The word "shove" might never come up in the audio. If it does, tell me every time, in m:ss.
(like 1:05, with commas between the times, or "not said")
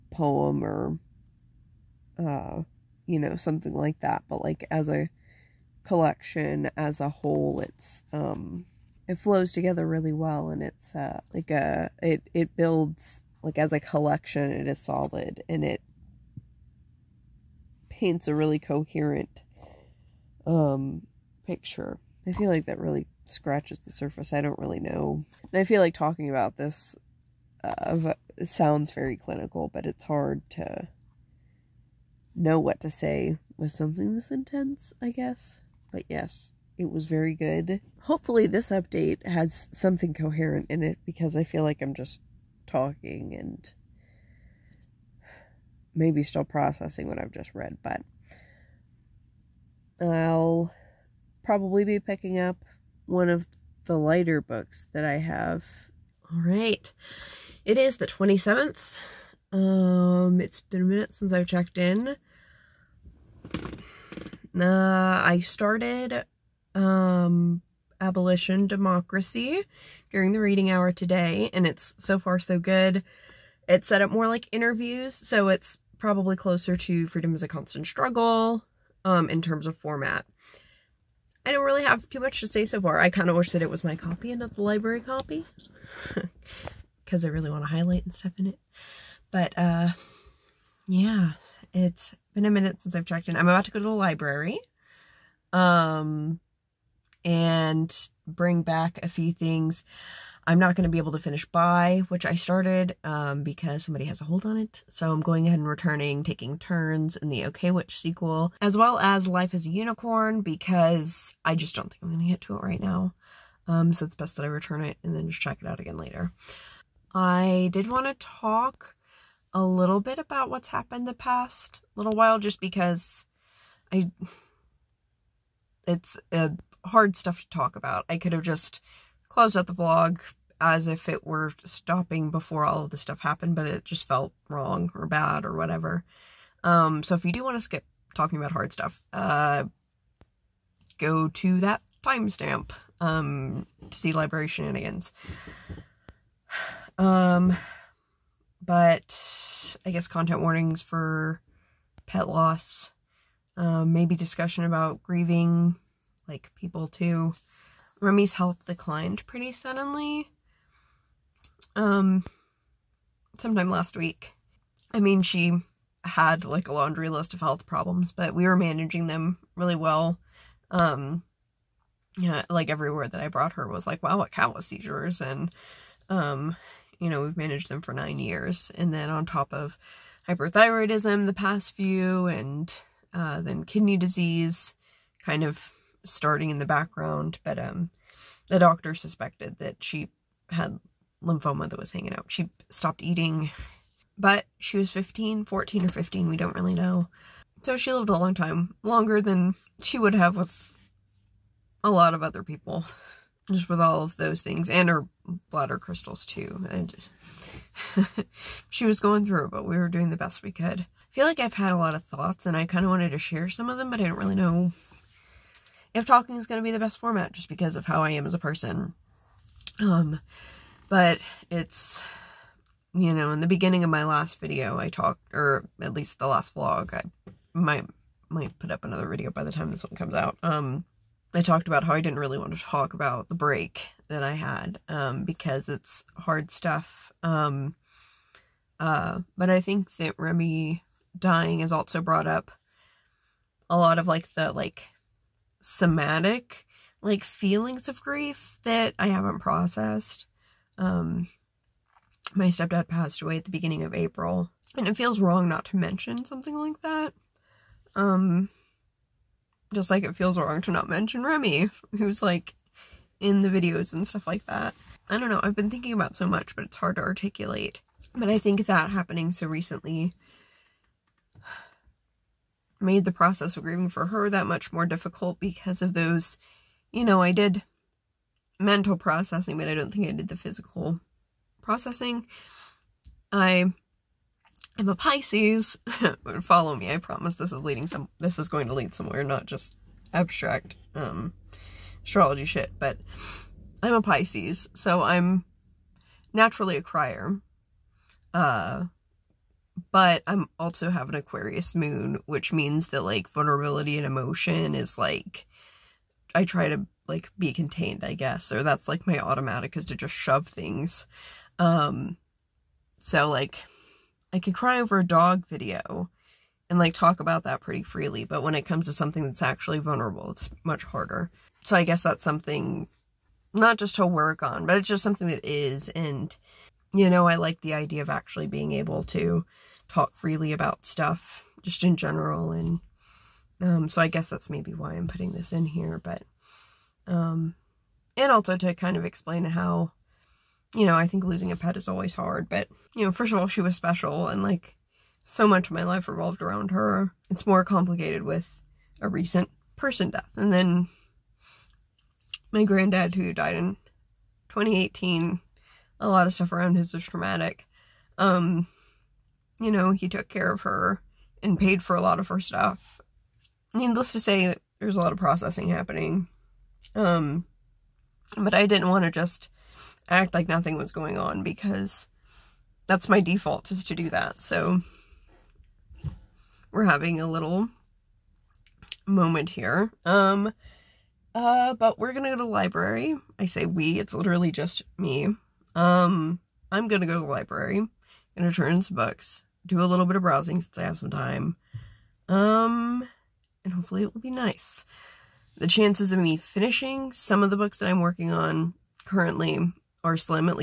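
5:10.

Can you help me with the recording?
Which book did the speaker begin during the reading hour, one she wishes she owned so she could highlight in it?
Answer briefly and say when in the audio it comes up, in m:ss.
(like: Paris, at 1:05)
Abolition Democracy, at 1:07.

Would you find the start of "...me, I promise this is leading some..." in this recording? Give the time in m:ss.
4:46.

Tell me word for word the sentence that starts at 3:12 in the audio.
She stopped eating, but she was 15, 14 or 15, we don't really know.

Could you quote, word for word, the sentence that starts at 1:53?
Um, so it's best that I return it and then just check it out again later.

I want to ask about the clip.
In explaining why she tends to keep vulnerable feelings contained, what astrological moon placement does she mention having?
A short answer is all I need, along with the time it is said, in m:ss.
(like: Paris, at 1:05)
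Aquarius moon, at 5:01.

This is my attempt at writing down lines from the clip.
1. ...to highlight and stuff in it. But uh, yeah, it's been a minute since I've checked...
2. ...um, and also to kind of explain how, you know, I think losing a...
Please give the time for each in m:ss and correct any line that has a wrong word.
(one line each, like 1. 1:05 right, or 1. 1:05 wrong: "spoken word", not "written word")
1. 1:27 right
2. 5:37 right.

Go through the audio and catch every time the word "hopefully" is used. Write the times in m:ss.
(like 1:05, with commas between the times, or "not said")
0:38, 6:33.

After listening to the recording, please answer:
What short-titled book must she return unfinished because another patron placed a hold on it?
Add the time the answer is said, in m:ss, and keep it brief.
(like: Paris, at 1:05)
Bi, at 1:41.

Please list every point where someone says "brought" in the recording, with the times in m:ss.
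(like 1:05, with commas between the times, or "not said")
2:53, 4:02.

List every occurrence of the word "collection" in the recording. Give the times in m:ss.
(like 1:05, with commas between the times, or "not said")
0:05, 0:13.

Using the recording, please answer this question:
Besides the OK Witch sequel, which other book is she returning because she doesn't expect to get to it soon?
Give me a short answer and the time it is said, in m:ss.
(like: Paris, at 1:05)
Life as a Unicorn, at 1:49.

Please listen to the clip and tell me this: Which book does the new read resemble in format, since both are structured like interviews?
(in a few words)
Freedom Is a Constant Struggle.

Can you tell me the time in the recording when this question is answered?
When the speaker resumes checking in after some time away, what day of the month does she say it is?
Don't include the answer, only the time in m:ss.
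0:58.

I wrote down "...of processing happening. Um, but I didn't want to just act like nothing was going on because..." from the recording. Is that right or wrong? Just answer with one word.
right.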